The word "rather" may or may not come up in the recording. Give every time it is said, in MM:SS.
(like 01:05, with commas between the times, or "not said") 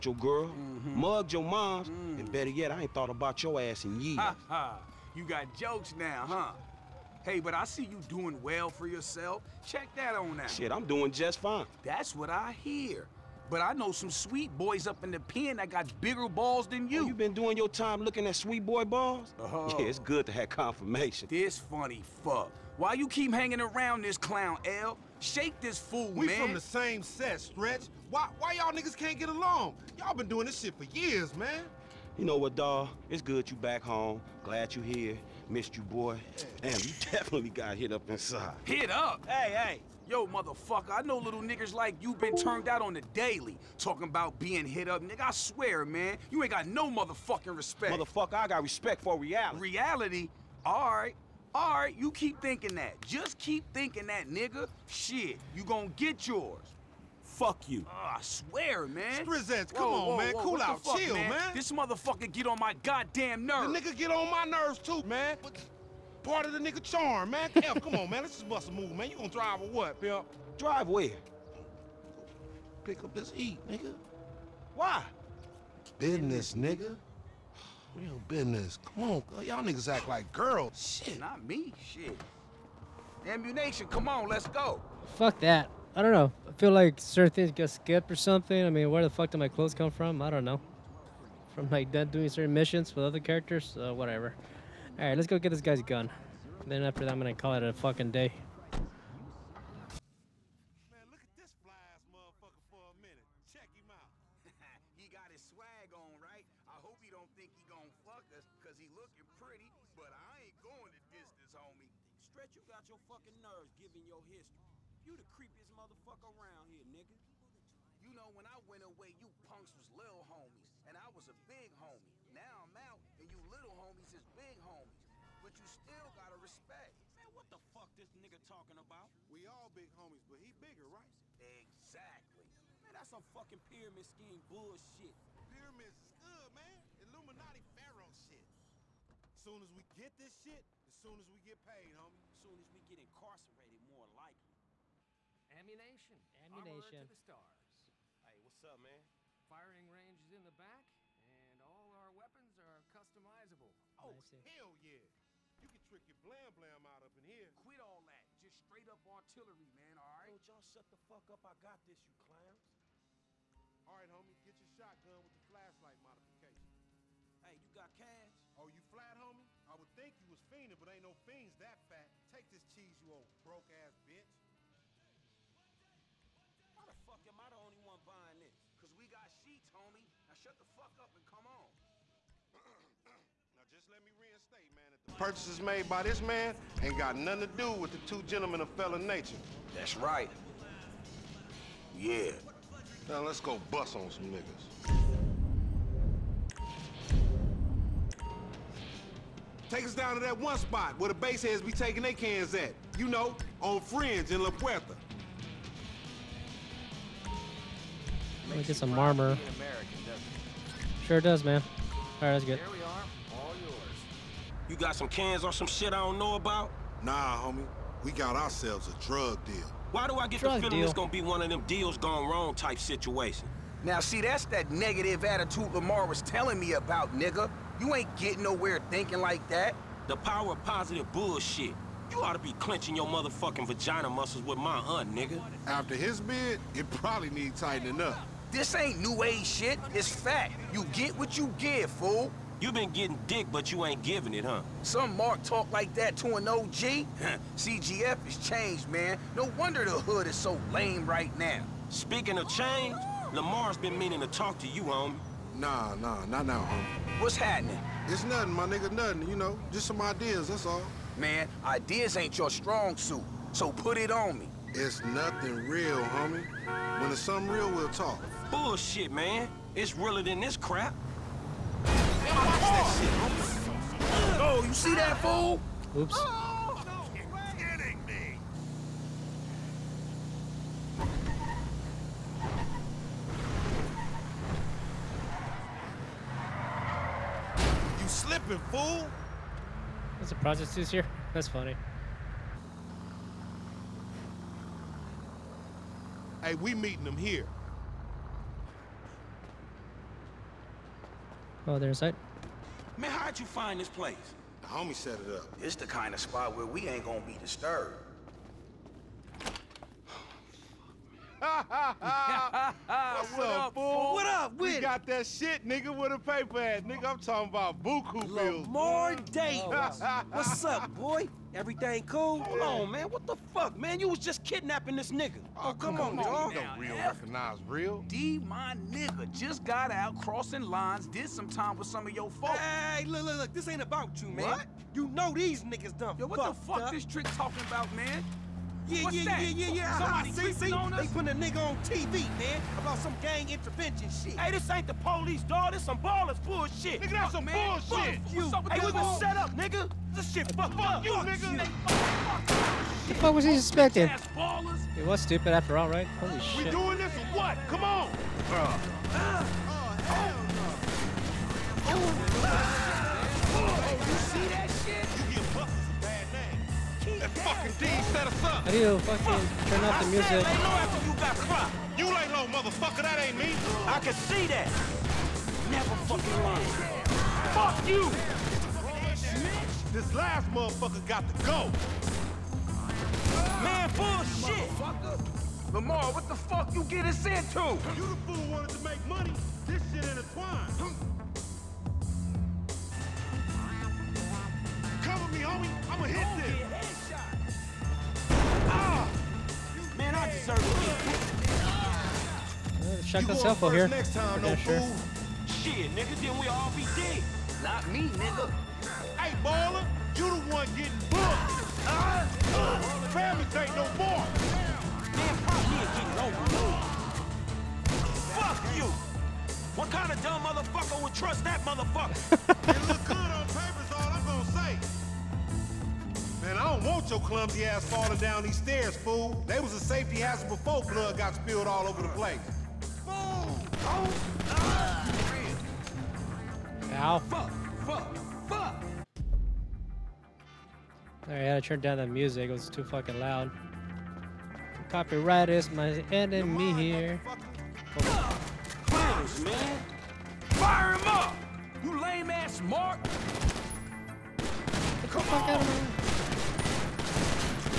not said.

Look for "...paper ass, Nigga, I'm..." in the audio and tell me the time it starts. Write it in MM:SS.
05:16.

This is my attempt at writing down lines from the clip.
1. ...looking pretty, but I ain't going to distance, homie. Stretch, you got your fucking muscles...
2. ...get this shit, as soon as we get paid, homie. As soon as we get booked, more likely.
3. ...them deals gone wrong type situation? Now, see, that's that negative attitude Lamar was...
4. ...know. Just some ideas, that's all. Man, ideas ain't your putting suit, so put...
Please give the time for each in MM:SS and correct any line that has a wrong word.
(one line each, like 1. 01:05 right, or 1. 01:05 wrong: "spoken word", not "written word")
1. 01:48 wrong: "nerves", not "muscles"
2. 02:19 wrong: "incarcerated", not "booked"
3. 03:41 right
4. 04:19 wrong: "strong", not "putting".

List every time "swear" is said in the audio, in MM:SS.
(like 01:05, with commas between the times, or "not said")
00:45, 00:58.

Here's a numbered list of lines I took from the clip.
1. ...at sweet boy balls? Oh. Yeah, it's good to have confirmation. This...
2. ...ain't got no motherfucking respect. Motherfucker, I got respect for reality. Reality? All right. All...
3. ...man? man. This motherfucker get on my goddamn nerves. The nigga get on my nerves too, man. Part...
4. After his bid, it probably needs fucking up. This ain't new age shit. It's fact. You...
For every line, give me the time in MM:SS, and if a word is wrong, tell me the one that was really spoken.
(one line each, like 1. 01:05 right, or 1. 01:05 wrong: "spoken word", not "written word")
1. 00:18 right
2. 00:46 right
3. 01:01 right
4. 03:55 wrong: "tightening", not "fucking".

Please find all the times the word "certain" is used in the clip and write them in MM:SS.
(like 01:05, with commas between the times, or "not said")
01:26, 01:32.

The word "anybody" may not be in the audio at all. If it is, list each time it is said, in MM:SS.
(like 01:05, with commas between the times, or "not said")
not said.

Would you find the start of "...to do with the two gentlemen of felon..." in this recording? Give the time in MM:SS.
03:07.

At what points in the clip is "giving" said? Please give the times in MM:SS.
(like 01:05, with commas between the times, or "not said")
01:53, 04:04.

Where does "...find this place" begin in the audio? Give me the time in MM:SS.
05:03.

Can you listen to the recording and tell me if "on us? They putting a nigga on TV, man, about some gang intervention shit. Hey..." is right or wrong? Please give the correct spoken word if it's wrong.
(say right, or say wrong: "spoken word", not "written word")
right.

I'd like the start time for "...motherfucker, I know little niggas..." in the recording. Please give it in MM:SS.
00:40.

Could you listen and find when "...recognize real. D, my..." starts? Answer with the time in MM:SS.
05:27.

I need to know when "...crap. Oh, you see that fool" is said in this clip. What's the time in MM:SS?
04:30.